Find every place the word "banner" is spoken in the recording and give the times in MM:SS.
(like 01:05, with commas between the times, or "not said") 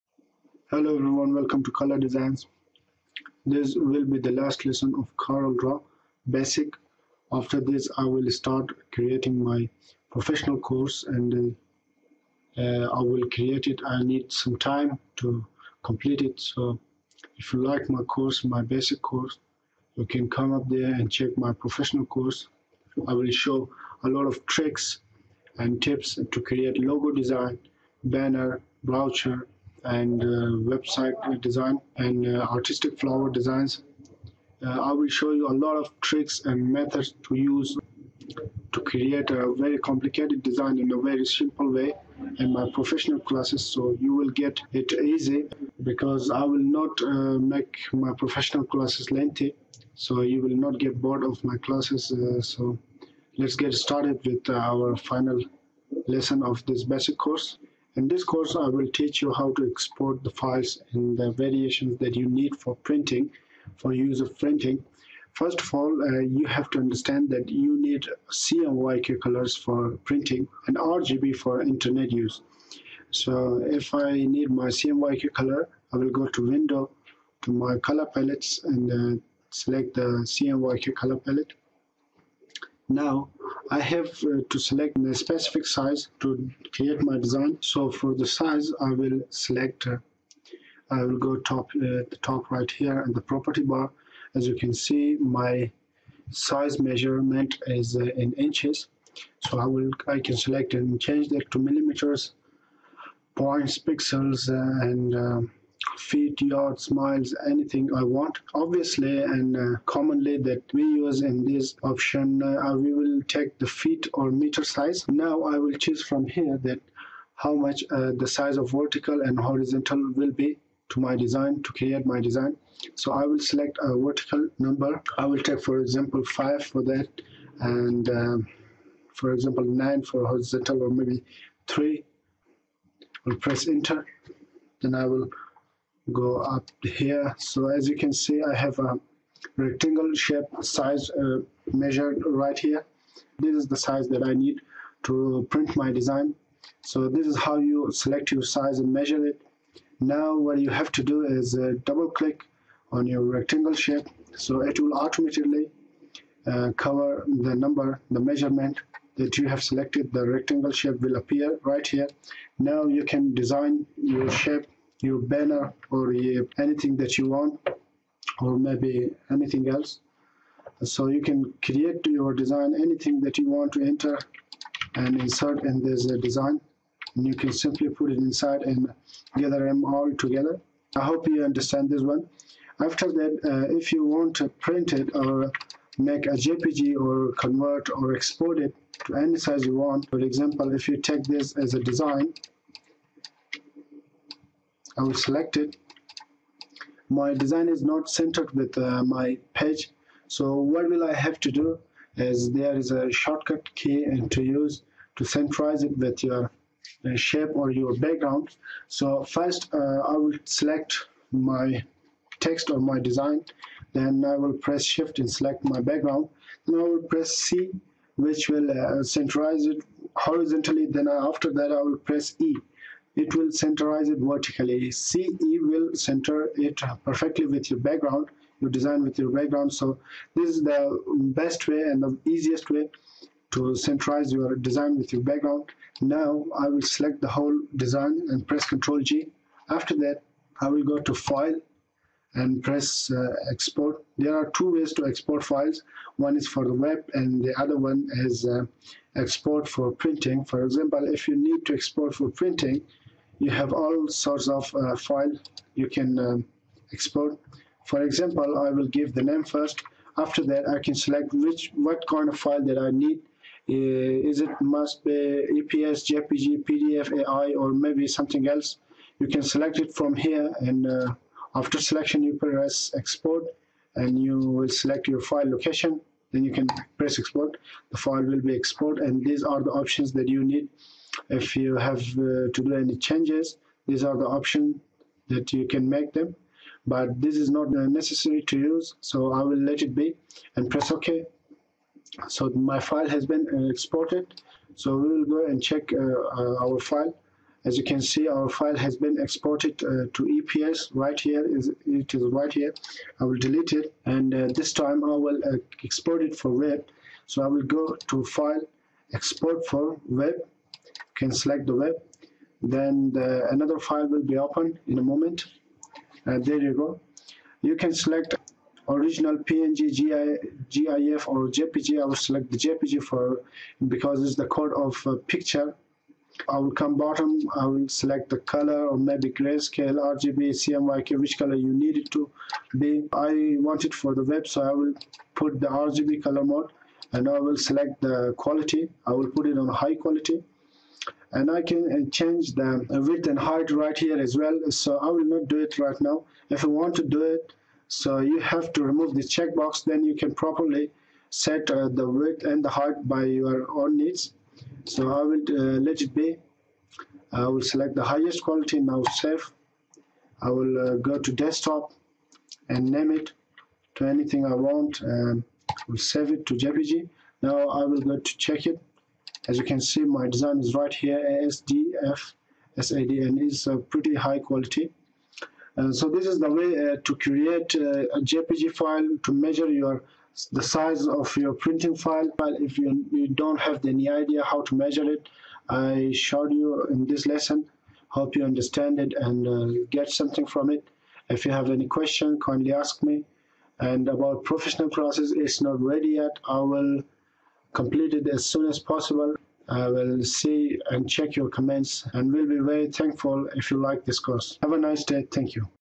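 00:28, 02:45.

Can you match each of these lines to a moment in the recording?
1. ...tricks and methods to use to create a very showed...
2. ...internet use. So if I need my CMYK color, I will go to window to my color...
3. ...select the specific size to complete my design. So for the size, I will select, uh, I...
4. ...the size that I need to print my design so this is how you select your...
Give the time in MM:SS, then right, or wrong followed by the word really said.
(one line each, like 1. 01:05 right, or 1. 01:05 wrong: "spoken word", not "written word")
1. 00:36 wrong: "complicated", not "showed"
2. 01:11 right
3. 01:24 wrong: "create", not "complete"
4. 02:23 right.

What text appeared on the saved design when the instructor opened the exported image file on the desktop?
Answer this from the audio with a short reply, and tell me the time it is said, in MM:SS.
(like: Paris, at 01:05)
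ASDF SAD, at 06:11.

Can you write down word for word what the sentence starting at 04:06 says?
One is for the web and the other one is uh, export for printing.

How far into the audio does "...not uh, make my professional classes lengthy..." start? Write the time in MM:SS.
00:46.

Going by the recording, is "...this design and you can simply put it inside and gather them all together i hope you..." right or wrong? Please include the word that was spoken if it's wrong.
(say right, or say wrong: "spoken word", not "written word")
right.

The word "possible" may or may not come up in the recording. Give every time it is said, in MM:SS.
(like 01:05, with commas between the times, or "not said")
06:38.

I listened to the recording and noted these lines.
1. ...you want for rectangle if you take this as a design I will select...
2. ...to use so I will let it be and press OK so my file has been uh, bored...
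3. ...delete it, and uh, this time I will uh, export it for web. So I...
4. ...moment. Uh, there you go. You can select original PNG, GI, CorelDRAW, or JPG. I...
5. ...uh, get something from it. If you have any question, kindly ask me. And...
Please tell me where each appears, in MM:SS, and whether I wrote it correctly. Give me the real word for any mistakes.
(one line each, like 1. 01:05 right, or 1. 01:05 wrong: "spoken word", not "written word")
1. 03:09 wrong: "example", not "rectangle"
2. 04:48 wrong: "exported", not "bored"
3. 05:03 right
4. 05:15 wrong: "GIF", not "CorelDRAW"
5. 06:29 right.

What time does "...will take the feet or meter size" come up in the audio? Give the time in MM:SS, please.
01:52.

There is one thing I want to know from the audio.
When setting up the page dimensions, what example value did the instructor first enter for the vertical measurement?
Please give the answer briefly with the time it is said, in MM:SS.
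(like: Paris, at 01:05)
5, at 02:06.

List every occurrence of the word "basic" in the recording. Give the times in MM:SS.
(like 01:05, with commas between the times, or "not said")
00:06, 00:18, 00:56.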